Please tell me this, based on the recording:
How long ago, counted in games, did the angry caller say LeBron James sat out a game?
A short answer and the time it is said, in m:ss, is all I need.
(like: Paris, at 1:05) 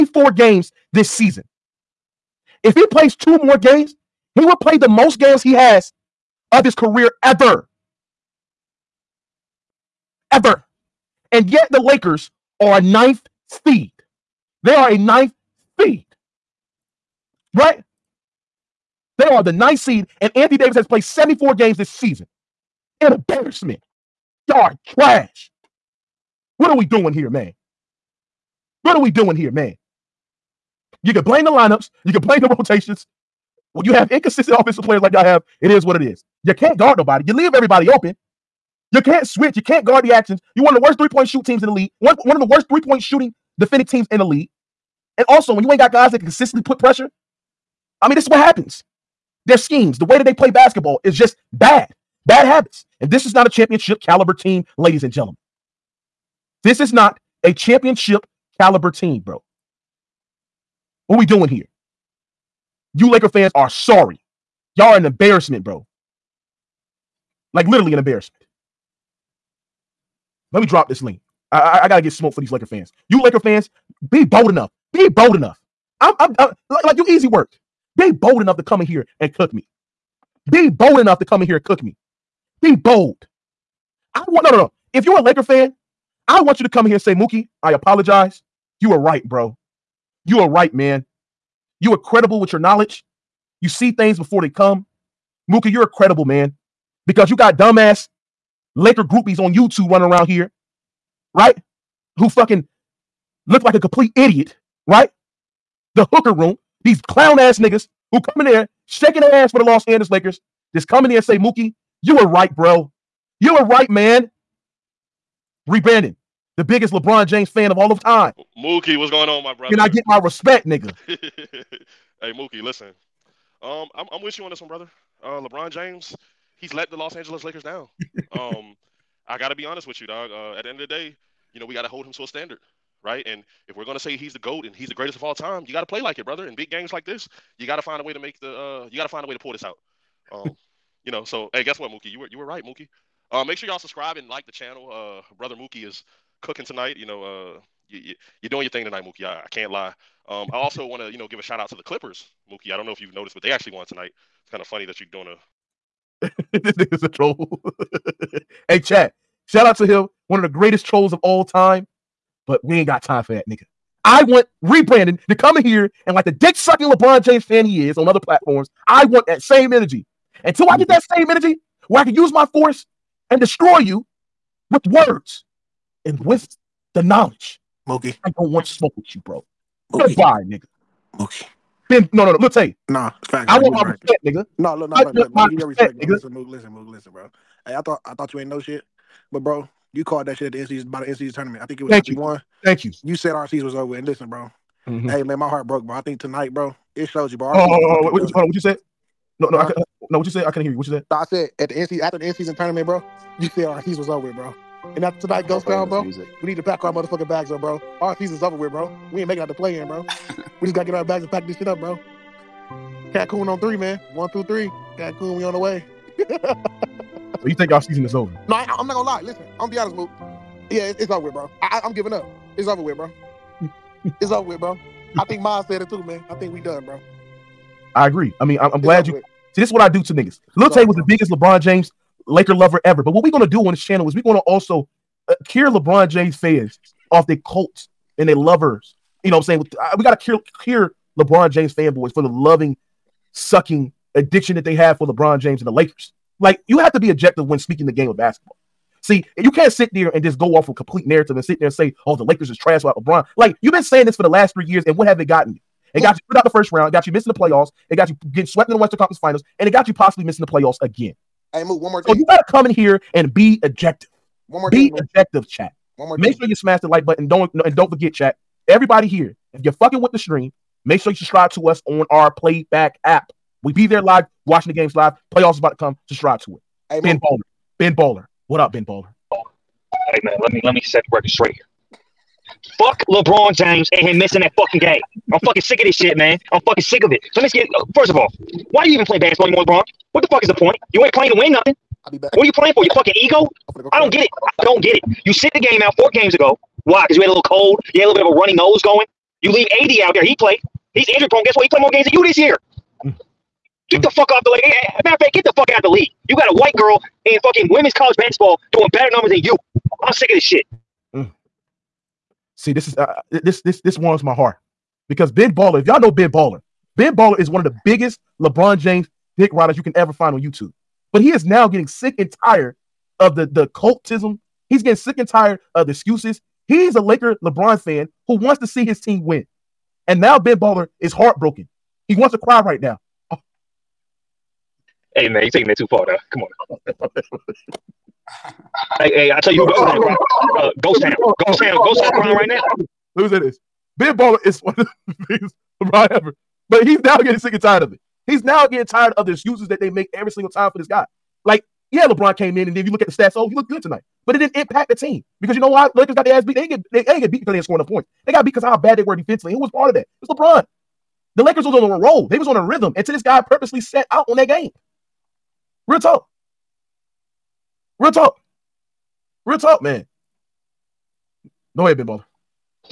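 4 games ago, at 4:55.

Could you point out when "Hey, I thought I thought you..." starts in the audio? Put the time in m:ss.
3:07.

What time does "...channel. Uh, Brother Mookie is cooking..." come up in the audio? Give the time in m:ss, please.
2:24.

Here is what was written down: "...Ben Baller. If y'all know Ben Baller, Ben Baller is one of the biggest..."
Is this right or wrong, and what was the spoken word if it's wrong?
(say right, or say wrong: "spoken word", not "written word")
right.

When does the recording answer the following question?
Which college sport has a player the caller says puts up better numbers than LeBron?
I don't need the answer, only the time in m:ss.
5:07.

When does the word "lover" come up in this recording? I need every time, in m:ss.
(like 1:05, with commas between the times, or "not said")
3:52, 3:58.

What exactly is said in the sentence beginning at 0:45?
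And also, when you ain't got guys that can consistently put pressure, I mean, this is what happens.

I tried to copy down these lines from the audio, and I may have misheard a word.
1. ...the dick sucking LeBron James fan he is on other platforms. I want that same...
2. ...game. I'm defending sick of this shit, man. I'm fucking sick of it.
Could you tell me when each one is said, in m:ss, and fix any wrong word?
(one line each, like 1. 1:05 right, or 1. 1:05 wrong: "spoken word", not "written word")
1. 2:46 right
2. 4:44 wrong: "fucking", not "defending".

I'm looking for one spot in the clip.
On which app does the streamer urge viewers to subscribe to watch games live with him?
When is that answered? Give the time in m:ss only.
4:32.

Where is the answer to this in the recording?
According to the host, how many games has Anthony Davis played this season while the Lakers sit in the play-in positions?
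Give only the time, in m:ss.
0:21.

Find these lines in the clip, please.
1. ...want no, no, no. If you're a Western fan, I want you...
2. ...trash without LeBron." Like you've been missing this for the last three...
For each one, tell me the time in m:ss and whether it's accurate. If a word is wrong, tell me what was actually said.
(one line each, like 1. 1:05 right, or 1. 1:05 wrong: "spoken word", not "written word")
1. 1:24 wrong: "Laker", not "Western"
2. 4:12 wrong: "saying", not "missing".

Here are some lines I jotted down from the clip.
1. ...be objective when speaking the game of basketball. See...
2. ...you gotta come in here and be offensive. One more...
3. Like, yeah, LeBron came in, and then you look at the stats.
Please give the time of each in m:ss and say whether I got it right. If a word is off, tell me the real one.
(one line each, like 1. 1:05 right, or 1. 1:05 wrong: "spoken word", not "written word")
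1. 4:06 right
2. 4:22 wrong: "objective", not "offensive"
3. 5:51 right.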